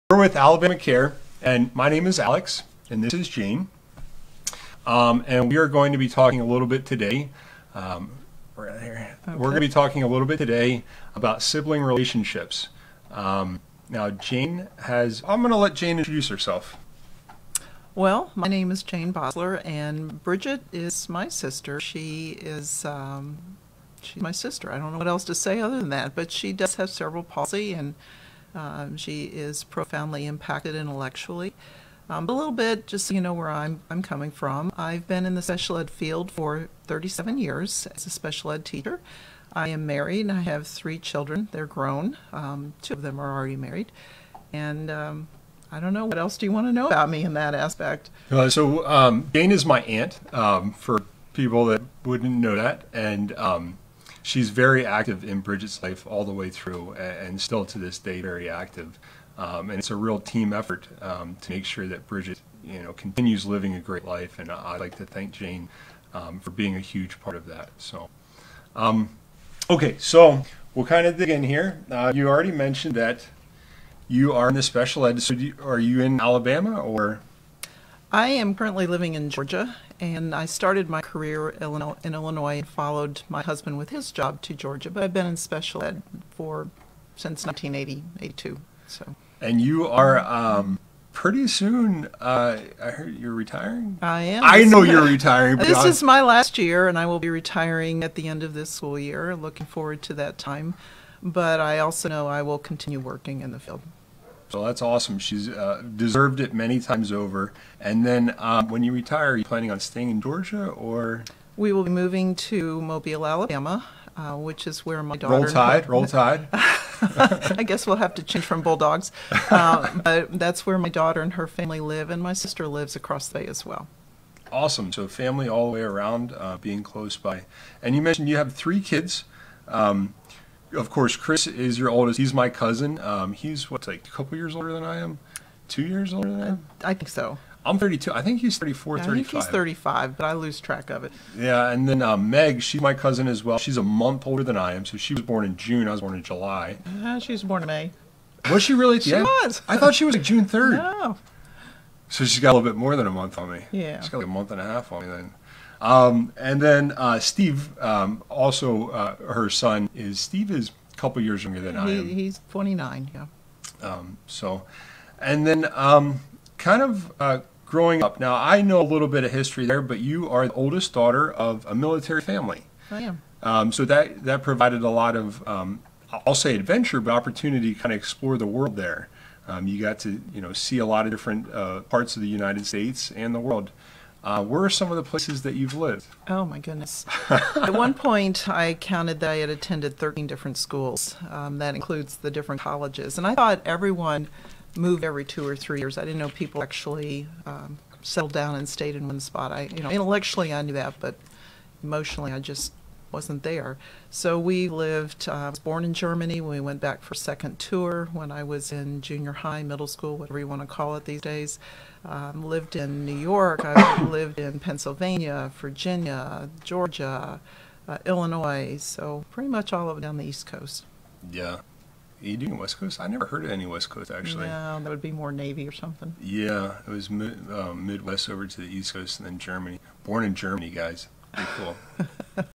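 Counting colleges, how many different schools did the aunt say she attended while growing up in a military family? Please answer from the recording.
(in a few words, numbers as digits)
13.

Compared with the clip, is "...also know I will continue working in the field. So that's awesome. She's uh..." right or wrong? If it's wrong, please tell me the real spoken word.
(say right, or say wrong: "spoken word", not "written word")
right.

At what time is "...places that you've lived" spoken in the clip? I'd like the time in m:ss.
3:05.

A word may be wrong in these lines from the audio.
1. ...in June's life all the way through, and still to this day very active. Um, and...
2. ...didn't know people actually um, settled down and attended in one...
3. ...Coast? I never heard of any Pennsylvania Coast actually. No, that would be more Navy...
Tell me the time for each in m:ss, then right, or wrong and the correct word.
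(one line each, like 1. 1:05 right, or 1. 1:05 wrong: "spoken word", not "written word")
1. 0:55 wrong: "Bridget", not "June"
2. 3:16 wrong: "stayed", not "attended"
3. 3:42 wrong: "West", not "Pennsylvania".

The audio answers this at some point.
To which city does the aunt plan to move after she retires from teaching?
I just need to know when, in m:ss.
1:52.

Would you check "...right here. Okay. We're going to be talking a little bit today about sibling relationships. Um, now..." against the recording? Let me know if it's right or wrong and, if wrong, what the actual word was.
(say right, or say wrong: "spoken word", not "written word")
right.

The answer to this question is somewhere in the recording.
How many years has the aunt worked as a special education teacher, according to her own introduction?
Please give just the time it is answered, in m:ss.
0:36.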